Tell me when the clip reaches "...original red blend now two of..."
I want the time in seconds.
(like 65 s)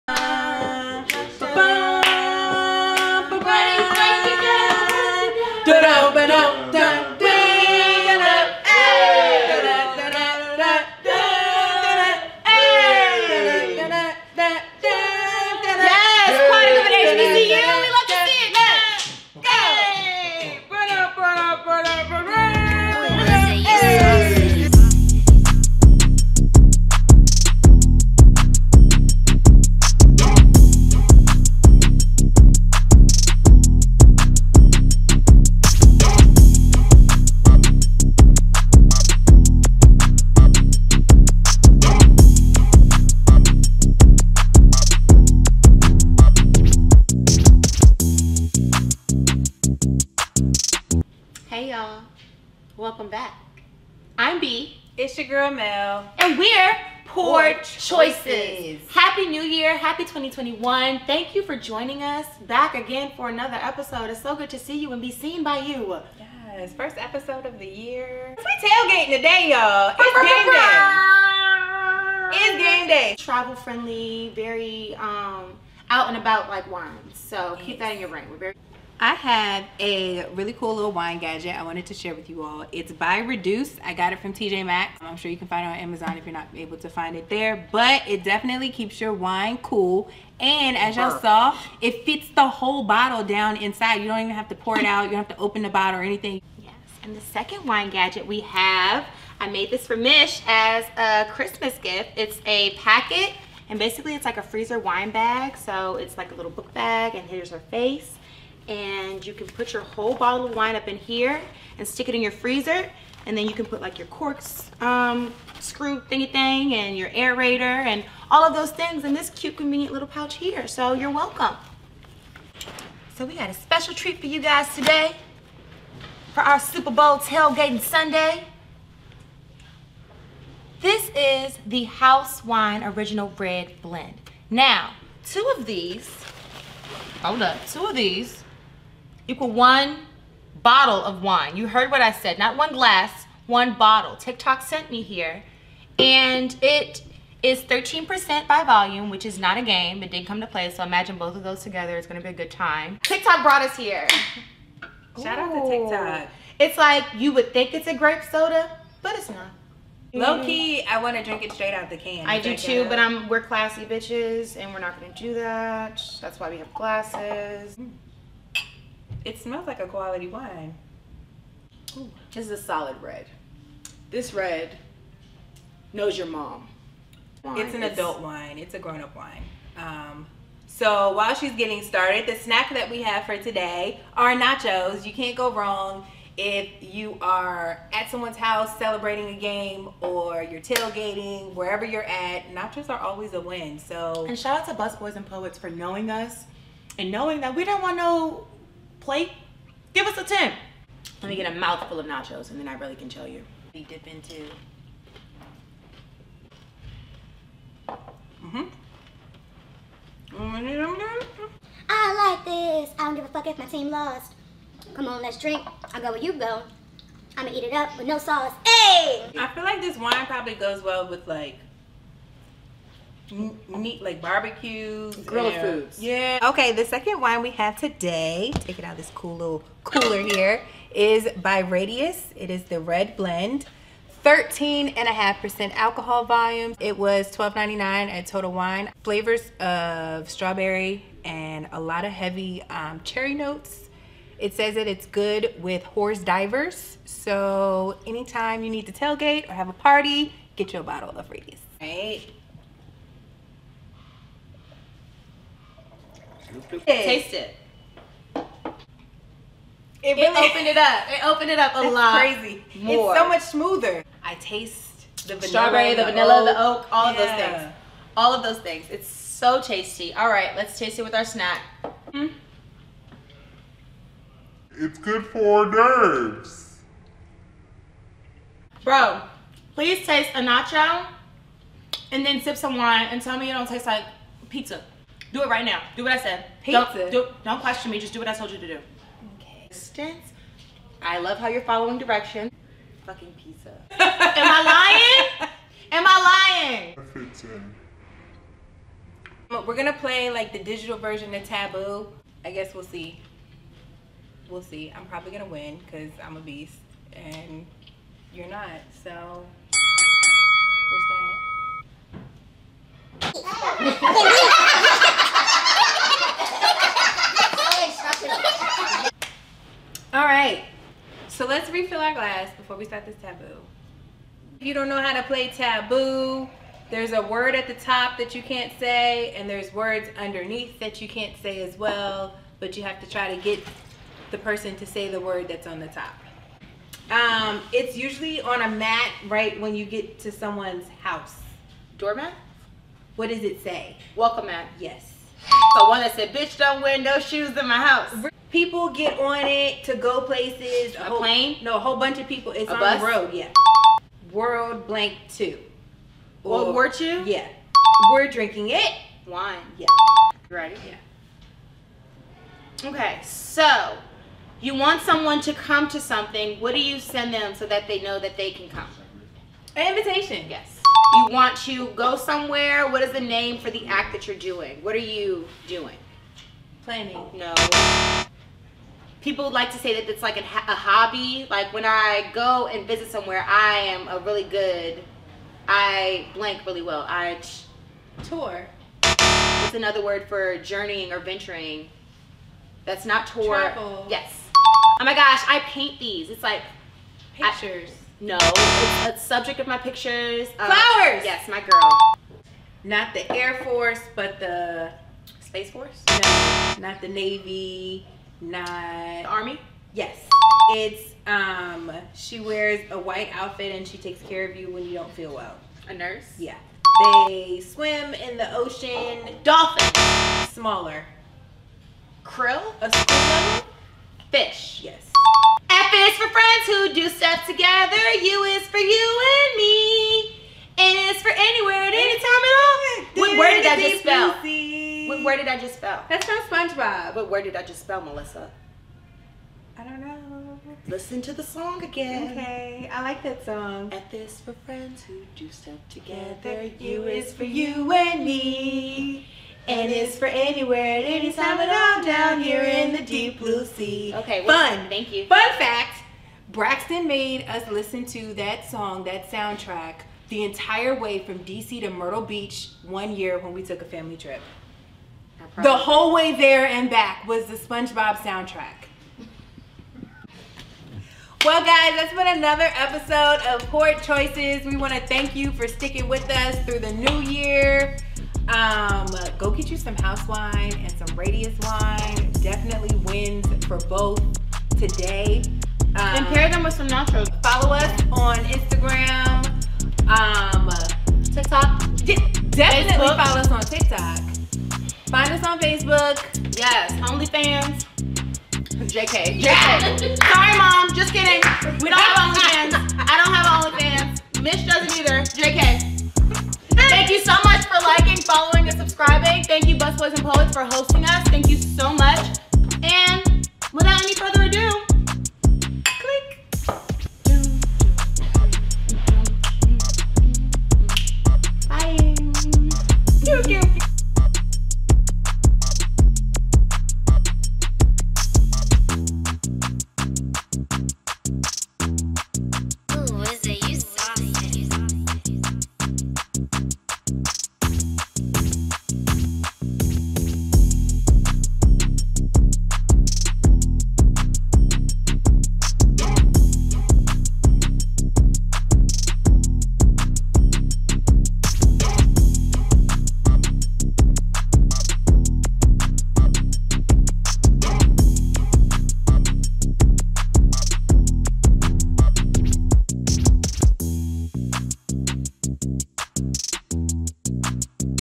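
132 s.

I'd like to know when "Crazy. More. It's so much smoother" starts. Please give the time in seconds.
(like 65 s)
262 s.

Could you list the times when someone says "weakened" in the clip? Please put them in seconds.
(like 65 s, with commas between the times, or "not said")
not said.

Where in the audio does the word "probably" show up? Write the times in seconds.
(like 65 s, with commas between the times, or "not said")
220 s, 305 s.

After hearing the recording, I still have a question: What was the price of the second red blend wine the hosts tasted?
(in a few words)
$12.99.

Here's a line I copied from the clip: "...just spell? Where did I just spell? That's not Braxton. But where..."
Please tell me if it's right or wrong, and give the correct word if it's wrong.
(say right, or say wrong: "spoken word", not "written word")
wrong: "SpongeBob", not "Braxton".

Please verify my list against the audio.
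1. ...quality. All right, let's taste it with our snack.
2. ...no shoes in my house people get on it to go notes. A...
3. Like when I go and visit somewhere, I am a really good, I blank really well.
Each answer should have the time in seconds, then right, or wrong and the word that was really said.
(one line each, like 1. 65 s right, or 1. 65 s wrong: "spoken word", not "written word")
1. 269 s wrong: "tasty", not "quality"
2. 346 s wrong: "places", not "notes"
3. 381 s right.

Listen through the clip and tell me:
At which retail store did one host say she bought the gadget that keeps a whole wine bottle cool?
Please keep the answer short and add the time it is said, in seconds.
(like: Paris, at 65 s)
TJ Maxx, at 84 s.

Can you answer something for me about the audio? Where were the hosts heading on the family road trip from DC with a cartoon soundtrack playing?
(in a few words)
Myrtle Beach.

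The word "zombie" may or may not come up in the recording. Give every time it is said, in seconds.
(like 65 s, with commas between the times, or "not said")
not said.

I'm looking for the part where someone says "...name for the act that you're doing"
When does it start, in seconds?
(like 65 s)
373 s.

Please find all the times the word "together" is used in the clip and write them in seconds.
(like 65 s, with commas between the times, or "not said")
151 s, 427 s, 445 s.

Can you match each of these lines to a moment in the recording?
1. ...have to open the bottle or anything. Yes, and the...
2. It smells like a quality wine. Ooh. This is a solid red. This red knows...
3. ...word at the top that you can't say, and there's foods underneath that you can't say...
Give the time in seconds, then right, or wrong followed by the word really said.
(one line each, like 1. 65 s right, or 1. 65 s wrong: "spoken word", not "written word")
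1. 95 s right
2. 169 s right
3. 327 s wrong: "words", not "foods".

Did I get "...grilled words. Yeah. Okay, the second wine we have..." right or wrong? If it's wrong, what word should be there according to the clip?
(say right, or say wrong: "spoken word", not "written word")
wrong: "foods", not "words".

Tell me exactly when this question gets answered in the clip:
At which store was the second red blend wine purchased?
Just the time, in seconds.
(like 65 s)
238 s.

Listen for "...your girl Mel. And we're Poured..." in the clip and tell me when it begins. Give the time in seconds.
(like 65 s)
55 s.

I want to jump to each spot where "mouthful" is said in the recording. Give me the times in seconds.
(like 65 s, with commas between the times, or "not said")
201 s.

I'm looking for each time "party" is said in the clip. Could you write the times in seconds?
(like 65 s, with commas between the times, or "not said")
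249 s.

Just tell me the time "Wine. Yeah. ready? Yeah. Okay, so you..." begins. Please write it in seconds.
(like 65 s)
359 s.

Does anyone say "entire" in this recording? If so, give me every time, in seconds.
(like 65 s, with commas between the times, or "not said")
460 s.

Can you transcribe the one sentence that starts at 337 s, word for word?
Um, it's usually on a mat right when you get to someone's house.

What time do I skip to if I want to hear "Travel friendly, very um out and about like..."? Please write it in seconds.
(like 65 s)
73 s.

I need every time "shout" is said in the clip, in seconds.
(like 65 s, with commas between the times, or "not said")
155 s, 194 s.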